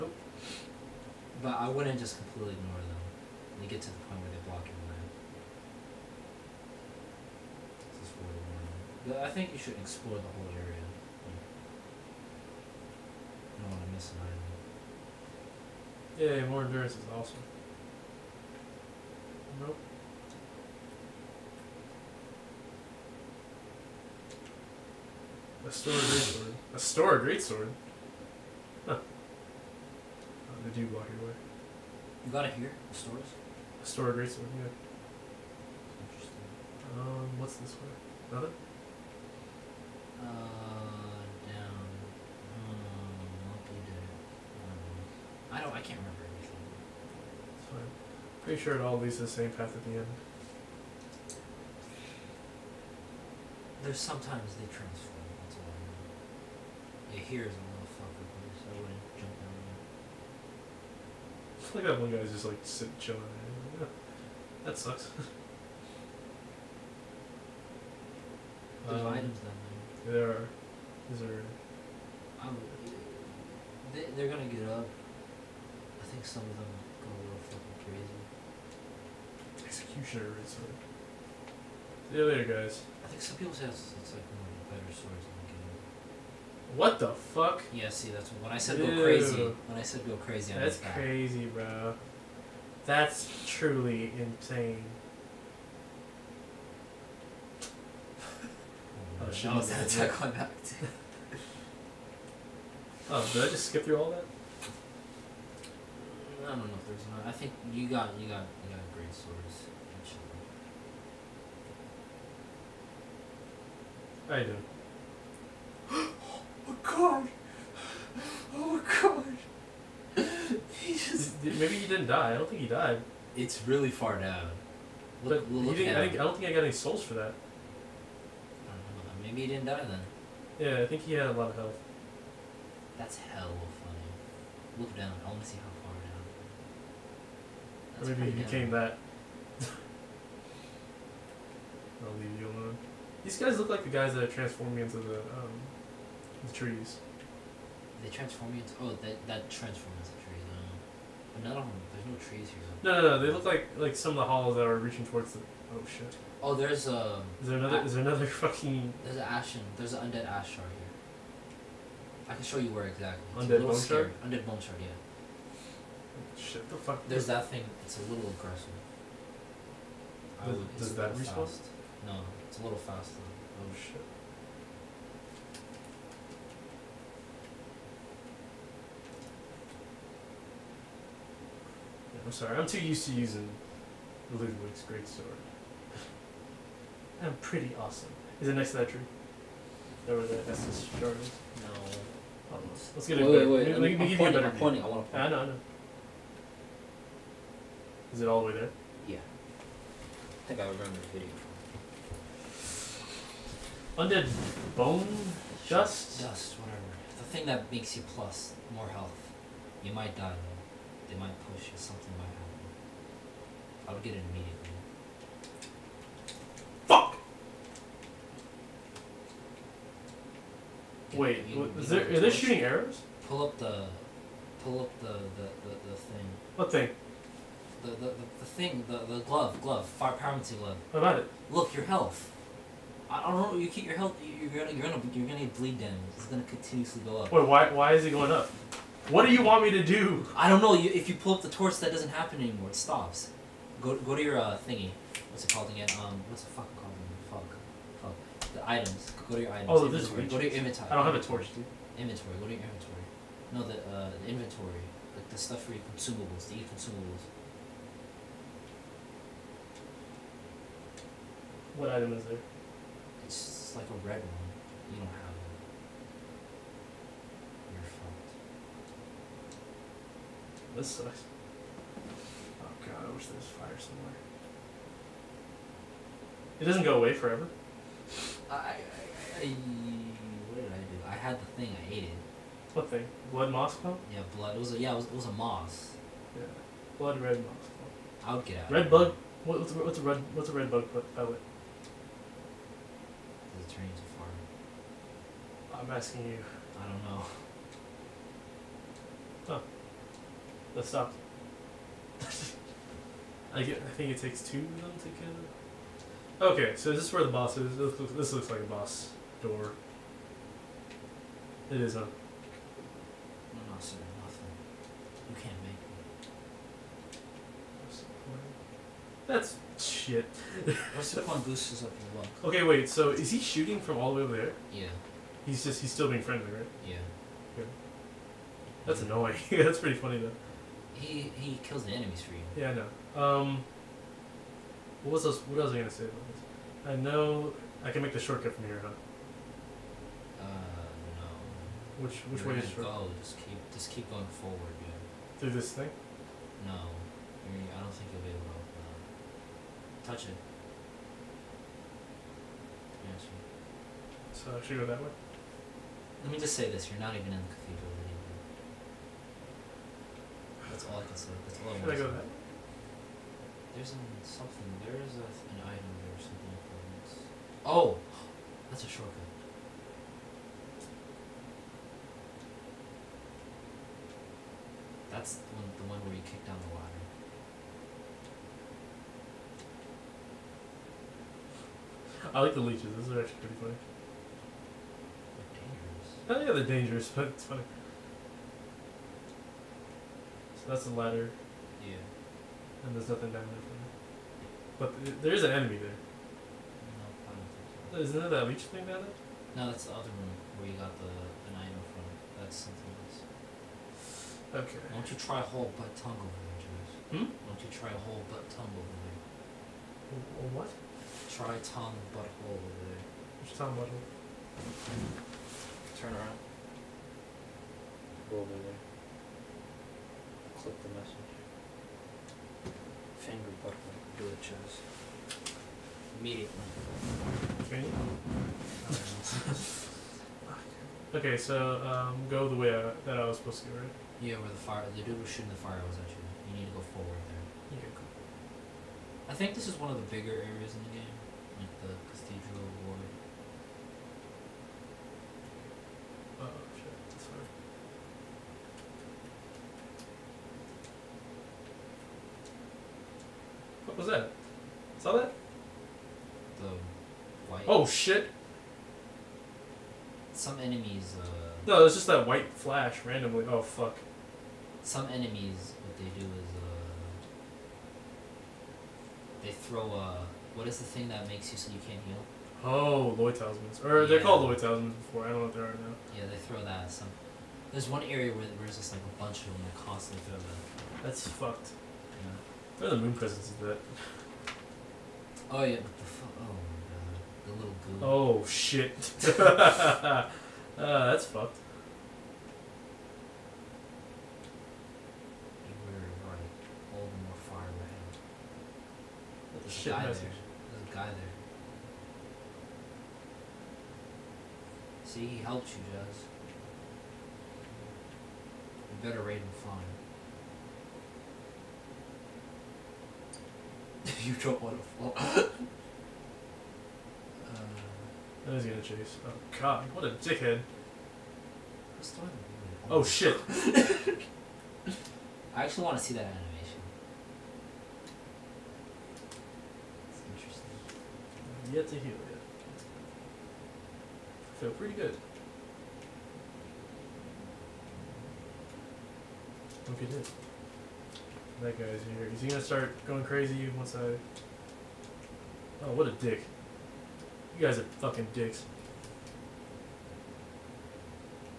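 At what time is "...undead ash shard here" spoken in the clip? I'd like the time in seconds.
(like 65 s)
160 s.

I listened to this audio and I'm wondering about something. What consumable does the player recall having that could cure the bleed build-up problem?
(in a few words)
Blood red moss clump.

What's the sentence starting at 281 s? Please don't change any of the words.
I had the thing I hated.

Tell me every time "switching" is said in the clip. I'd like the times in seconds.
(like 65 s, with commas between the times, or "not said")
not said.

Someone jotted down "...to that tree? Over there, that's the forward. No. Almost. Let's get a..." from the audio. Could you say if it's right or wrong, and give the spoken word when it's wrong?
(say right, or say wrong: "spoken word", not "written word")
wrong: "shard", not "forward".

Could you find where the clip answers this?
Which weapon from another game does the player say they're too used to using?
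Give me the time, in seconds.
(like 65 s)
184 s.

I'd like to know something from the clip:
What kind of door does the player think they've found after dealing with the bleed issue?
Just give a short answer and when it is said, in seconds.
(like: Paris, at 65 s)
Boss door, at 308 s.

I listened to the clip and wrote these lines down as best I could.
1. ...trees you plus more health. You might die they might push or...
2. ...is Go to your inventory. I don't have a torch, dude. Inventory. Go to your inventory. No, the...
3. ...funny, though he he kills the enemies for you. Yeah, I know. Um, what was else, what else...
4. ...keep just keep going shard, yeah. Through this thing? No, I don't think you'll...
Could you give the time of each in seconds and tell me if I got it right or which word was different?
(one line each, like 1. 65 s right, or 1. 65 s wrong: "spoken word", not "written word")
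1. 207 s wrong: "makes", not "trees"
2. 250 s right
3. 329 s right
4. 343 s wrong: "forward", not "shard".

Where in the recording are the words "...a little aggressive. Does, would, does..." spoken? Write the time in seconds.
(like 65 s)
167 s.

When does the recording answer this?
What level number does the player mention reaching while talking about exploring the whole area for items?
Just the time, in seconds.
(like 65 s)
8 s.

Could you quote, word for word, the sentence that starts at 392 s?
and there's nothing down there for me.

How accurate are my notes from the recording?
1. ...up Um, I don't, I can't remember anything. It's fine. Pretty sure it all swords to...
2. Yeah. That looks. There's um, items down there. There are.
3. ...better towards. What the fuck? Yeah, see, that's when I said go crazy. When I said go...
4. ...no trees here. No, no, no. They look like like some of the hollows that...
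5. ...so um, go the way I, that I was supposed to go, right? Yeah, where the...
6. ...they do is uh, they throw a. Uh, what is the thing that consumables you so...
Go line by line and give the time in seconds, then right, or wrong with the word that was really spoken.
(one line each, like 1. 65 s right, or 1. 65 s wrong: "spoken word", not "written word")
1. 43 s wrong: "leads", not "swords"
2. 63 s wrong: "sucks", not "looks"
3. 84 s wrong: "swords", not "towards"
4. 152 s right
5. 431 s right
6. 465 s wrong: "makes", not "consumables".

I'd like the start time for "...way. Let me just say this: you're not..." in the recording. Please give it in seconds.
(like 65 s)
354 s.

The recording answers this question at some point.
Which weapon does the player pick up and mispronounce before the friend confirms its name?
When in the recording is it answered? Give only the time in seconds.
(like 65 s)
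33 s.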